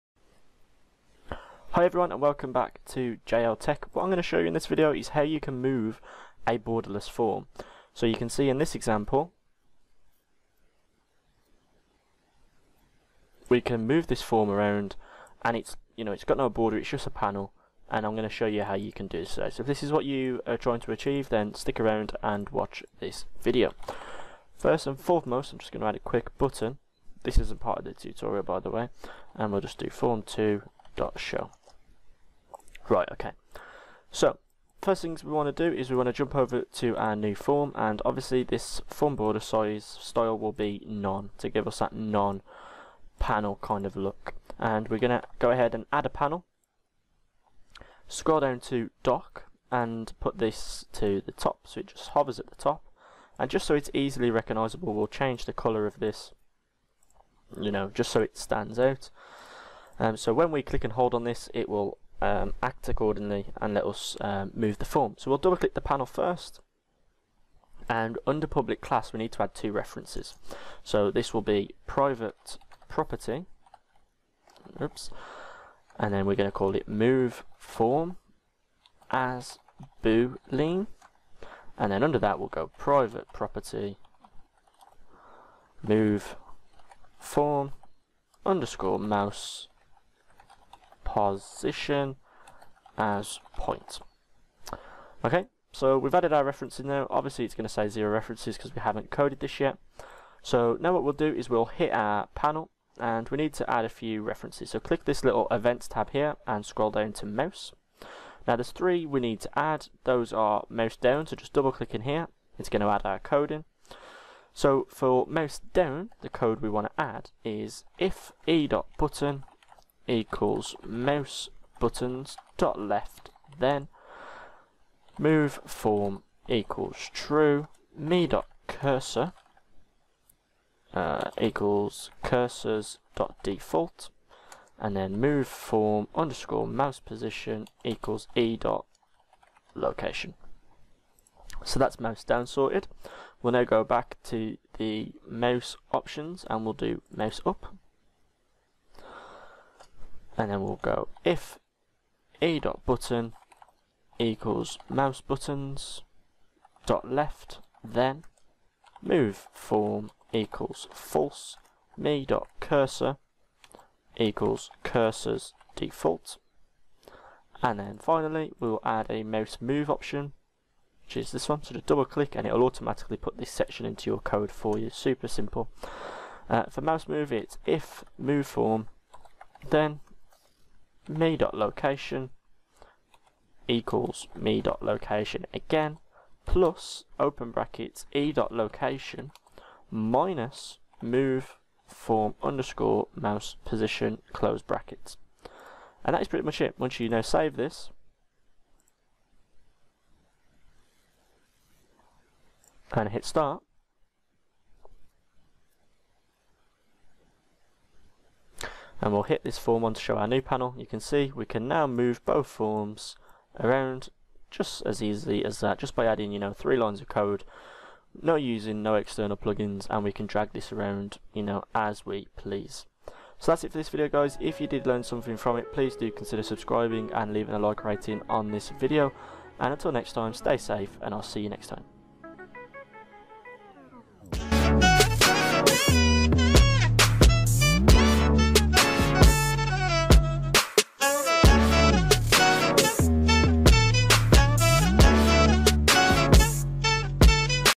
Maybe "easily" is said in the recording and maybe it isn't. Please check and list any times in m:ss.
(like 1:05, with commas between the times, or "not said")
0:53, 3:35.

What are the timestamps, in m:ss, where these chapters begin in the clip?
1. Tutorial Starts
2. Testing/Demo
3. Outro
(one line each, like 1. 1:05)
1. 0:40
2. 3:28
3. 3:50.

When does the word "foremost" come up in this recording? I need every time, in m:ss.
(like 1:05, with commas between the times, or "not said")
0:24.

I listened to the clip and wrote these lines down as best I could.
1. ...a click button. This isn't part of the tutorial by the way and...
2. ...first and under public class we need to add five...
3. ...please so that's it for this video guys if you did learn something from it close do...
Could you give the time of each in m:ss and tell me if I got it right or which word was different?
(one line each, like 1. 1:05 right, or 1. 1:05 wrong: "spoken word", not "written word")
1. 0:25 wrong: "quick", not "click"
2. 1:06 wrong: "two", not "five"
3. 3:42 wrong: "please", not "close".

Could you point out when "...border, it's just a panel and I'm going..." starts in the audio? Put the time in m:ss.
0:16.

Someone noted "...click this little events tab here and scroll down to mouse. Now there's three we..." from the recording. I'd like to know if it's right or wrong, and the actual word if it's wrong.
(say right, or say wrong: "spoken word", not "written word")
right.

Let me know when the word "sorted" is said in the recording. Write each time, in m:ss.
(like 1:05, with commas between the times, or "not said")
2:22.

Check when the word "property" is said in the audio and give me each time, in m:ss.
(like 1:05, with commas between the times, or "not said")
1:12, 1:23.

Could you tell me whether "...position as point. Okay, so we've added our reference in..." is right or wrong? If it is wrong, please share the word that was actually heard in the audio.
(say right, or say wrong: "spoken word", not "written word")
right.